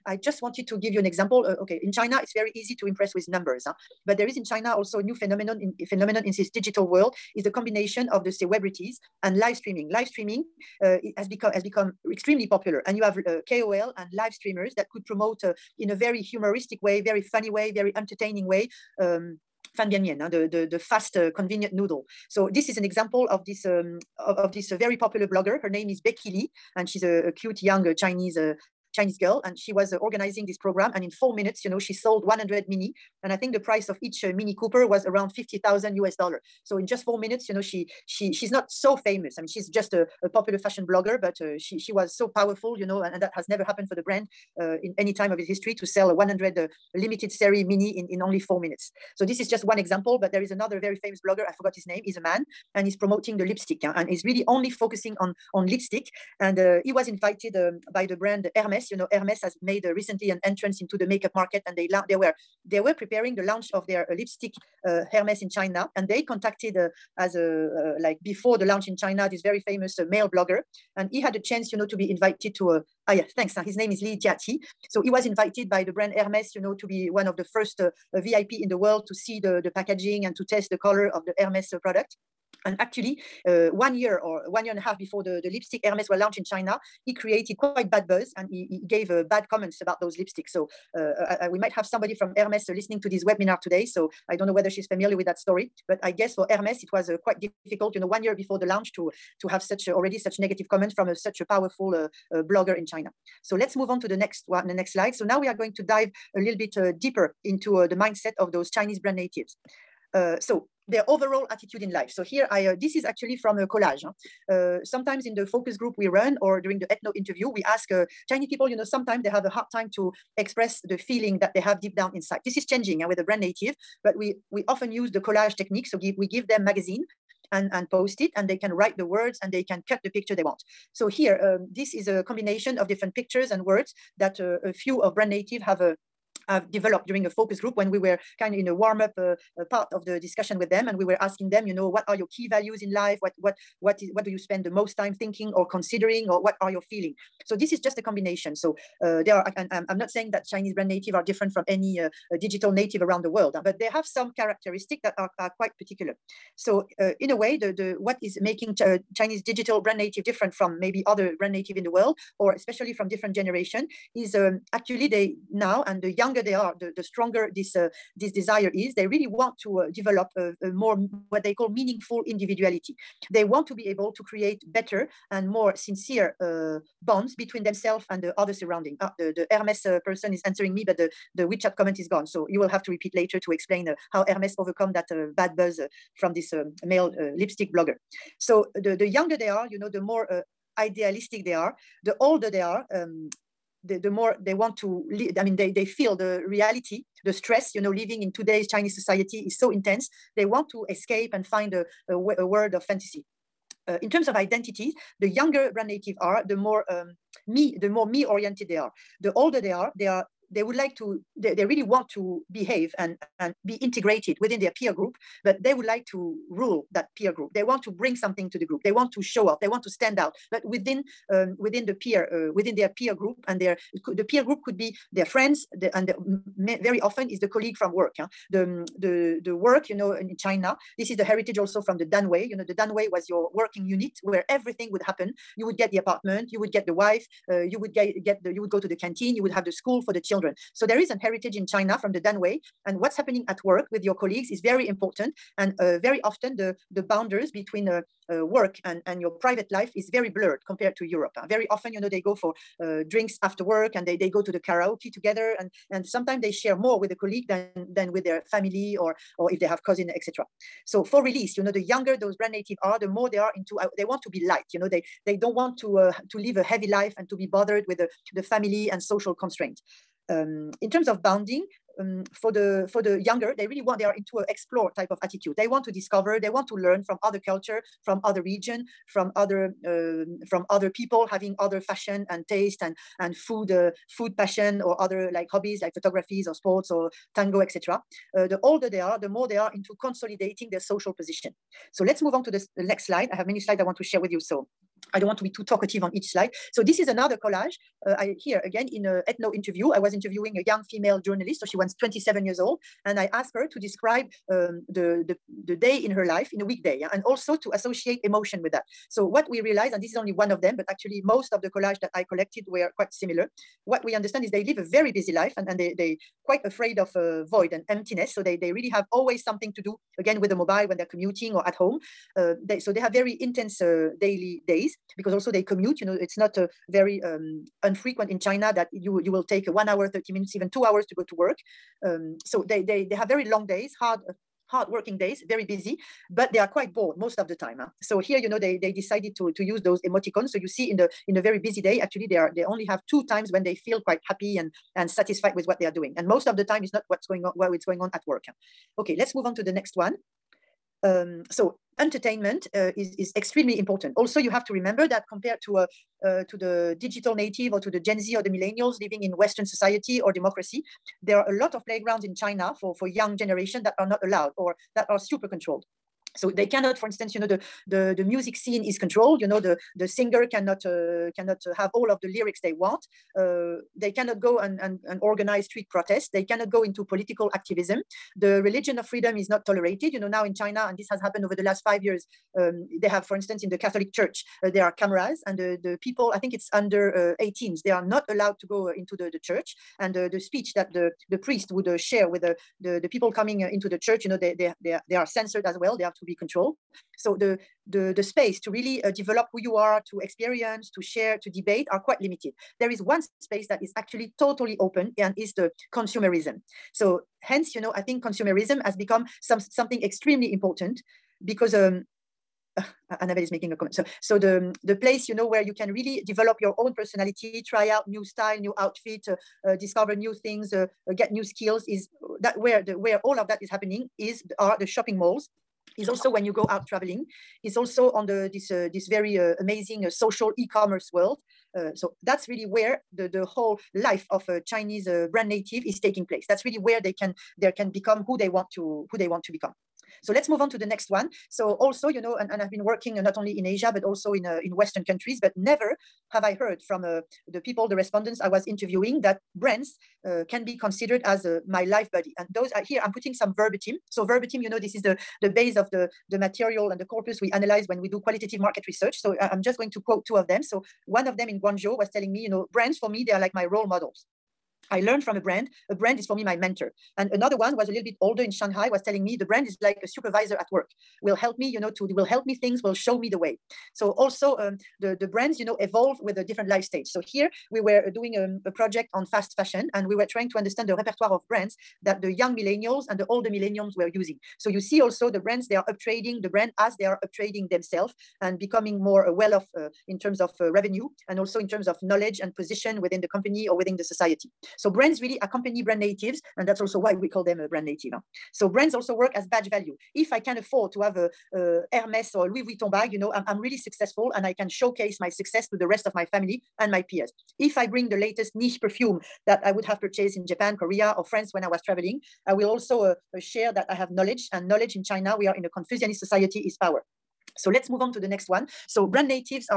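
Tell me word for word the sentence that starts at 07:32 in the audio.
And those are here, I'm putting some verbatim.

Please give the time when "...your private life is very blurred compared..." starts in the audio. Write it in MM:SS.
04:09.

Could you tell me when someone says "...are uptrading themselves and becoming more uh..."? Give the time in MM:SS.
08:07.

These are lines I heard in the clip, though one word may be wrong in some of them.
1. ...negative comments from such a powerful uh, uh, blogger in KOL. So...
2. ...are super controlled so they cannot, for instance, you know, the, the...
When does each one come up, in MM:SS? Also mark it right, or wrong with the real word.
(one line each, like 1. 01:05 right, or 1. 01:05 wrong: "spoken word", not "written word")
1. 01:40 wrong: "China", not "KOL"
2. 06:05 right.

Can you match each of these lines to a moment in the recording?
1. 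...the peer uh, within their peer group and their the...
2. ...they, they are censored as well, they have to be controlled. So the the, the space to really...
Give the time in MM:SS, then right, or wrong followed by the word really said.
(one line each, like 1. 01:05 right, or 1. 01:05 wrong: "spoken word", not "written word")
1. 03:41 right
2. 06:34 right.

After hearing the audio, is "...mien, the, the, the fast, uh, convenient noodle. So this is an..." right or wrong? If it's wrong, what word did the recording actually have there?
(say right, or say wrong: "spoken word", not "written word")
right.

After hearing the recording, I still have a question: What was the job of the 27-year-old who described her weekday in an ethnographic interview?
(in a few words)
Journalist.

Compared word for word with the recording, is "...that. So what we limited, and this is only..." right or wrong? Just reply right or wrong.
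wrong.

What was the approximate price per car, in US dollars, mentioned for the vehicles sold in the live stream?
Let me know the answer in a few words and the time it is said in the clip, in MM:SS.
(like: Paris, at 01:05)
50,000, at 00:35.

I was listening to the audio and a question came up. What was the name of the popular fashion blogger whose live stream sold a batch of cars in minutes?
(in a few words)
Becky Li.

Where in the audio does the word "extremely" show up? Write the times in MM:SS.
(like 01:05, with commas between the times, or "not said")
00:12, 05:53, 06:50.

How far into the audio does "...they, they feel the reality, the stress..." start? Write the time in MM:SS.
03:15.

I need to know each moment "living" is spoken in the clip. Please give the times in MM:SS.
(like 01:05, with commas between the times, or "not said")
03:17, 05:59.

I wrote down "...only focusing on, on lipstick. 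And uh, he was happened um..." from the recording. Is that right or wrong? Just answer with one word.
wrong.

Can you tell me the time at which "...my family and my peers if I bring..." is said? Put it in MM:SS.
08:26.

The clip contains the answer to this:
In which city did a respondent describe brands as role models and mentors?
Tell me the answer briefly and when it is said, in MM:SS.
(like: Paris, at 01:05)
Guangzhou, at 07:41.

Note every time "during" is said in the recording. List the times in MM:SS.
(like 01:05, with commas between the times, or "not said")
01:56, 02:17.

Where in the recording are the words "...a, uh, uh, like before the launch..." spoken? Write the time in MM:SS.
01:07.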